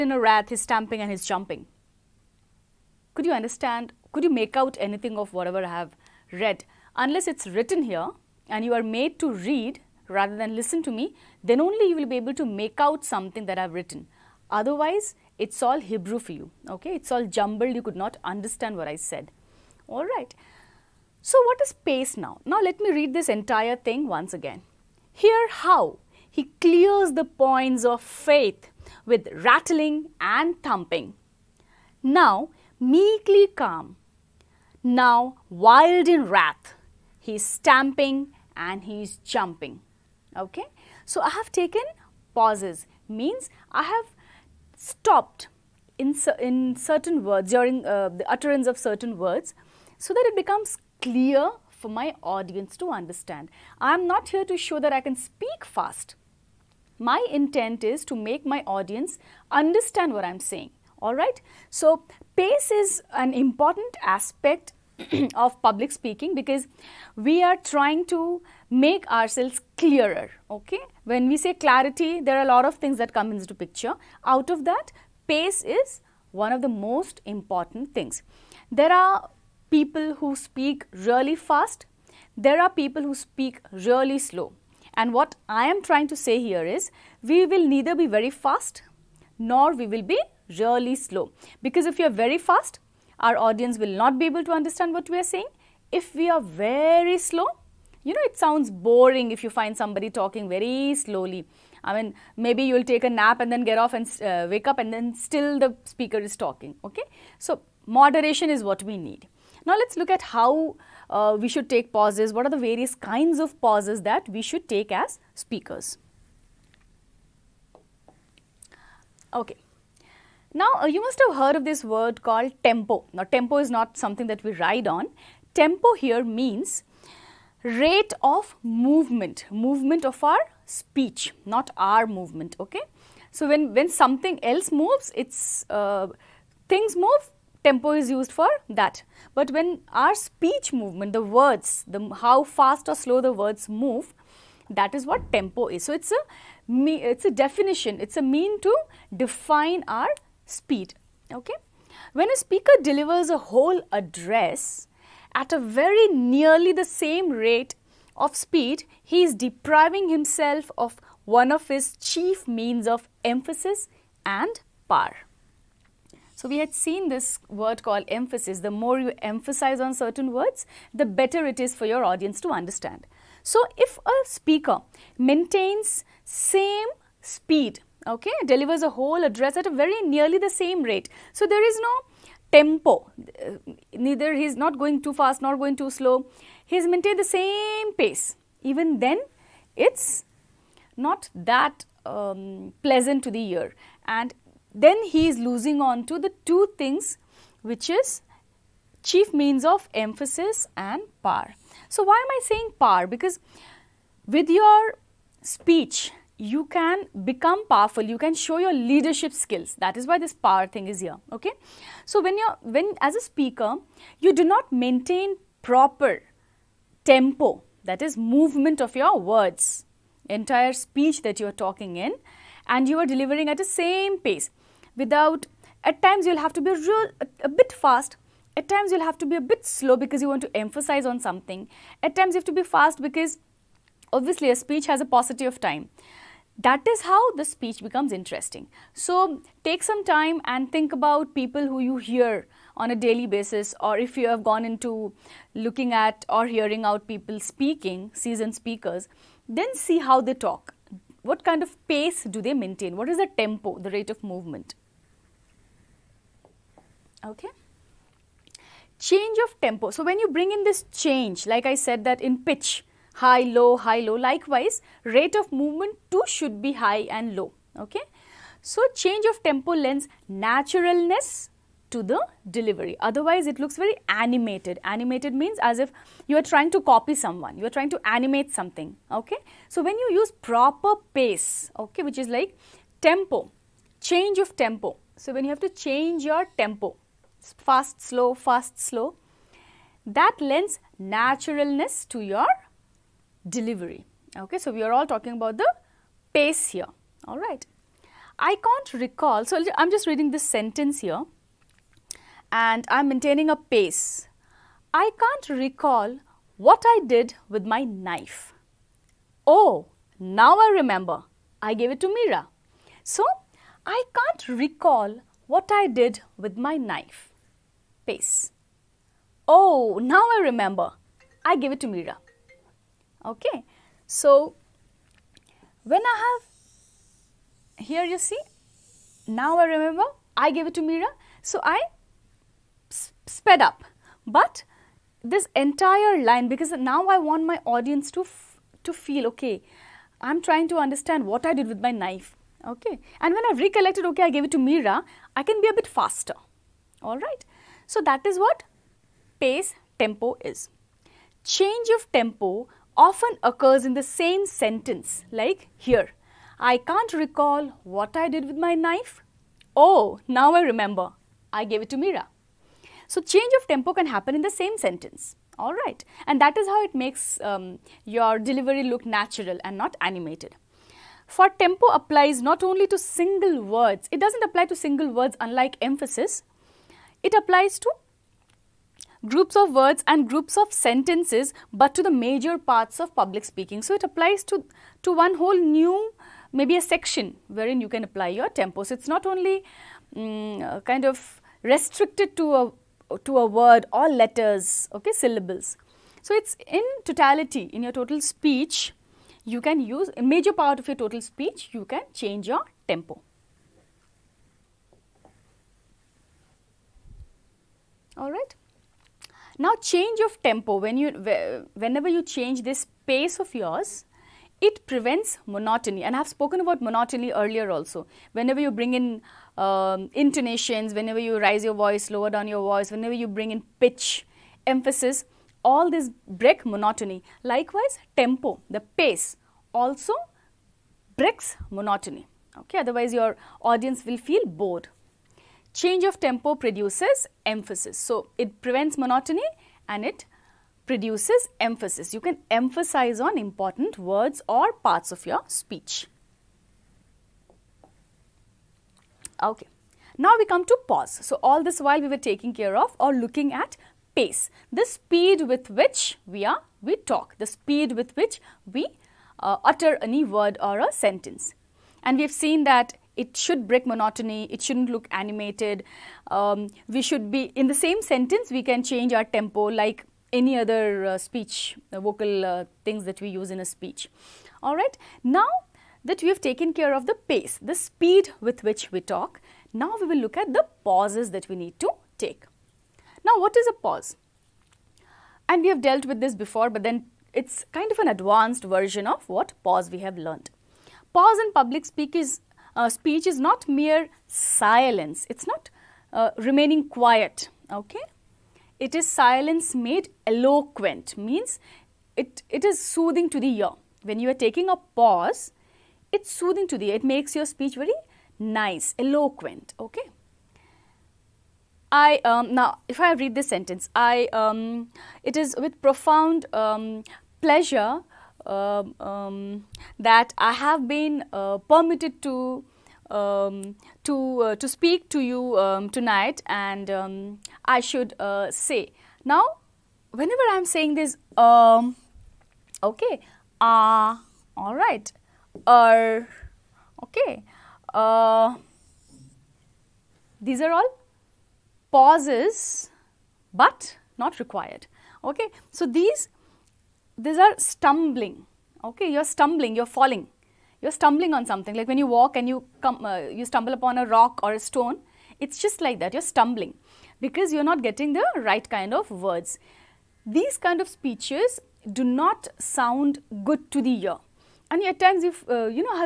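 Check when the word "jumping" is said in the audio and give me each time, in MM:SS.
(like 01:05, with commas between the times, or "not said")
00:01, 00:39.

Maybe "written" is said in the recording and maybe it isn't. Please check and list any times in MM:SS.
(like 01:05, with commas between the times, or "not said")
00:07, 00:13.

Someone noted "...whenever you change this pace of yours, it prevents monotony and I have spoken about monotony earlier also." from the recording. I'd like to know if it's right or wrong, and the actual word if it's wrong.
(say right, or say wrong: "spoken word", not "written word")
right.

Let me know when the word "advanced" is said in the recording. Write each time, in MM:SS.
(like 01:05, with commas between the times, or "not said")
08:08.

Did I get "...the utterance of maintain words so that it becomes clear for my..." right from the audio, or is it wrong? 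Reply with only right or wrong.
wrong.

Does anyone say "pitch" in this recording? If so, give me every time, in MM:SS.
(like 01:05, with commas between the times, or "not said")
04:22, 07:03.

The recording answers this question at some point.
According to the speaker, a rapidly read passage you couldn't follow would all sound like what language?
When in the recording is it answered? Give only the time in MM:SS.
00:15.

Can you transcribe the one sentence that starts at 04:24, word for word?
Likewise, rate of movement too should be high and low.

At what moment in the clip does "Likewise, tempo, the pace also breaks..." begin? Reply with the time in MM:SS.
07:07.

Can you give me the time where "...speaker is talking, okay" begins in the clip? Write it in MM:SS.
01:45.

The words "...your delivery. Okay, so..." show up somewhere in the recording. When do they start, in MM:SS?
04:52.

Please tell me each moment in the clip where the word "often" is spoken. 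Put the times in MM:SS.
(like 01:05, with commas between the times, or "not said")
05:53.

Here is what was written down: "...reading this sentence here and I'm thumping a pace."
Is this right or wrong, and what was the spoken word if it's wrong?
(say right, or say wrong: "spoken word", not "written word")
wrong: "maintaining", not "thumping".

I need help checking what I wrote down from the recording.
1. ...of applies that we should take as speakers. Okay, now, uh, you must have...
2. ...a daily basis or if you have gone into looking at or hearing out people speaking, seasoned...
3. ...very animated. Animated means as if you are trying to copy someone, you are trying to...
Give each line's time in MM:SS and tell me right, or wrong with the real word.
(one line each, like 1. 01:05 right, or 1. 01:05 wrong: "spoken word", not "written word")
1. 01:53 wrong: "pauses", not "applies"
2. 04:02 right
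3. 04:33 right.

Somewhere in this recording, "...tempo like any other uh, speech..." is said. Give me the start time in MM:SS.
07:49.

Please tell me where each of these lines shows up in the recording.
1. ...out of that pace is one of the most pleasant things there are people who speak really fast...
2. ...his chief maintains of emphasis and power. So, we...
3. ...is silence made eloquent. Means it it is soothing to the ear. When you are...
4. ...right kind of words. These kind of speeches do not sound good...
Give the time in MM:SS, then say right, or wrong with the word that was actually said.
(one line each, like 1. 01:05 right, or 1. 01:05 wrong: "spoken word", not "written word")
1. 01:14 wrong: "important", not "pleasant"
2. 02:41 wrong: "means", not "maintains"
3. 08:18 right
4. 09:18 right.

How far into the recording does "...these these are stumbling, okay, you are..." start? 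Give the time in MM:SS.
09:05.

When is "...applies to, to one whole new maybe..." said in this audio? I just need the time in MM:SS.
06:24.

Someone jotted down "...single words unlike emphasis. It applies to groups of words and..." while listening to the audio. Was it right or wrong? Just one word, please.
right.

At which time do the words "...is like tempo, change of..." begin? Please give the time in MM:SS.
04:42.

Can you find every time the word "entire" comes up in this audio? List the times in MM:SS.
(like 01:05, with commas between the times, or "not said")
00:23, 03:40, 05:35.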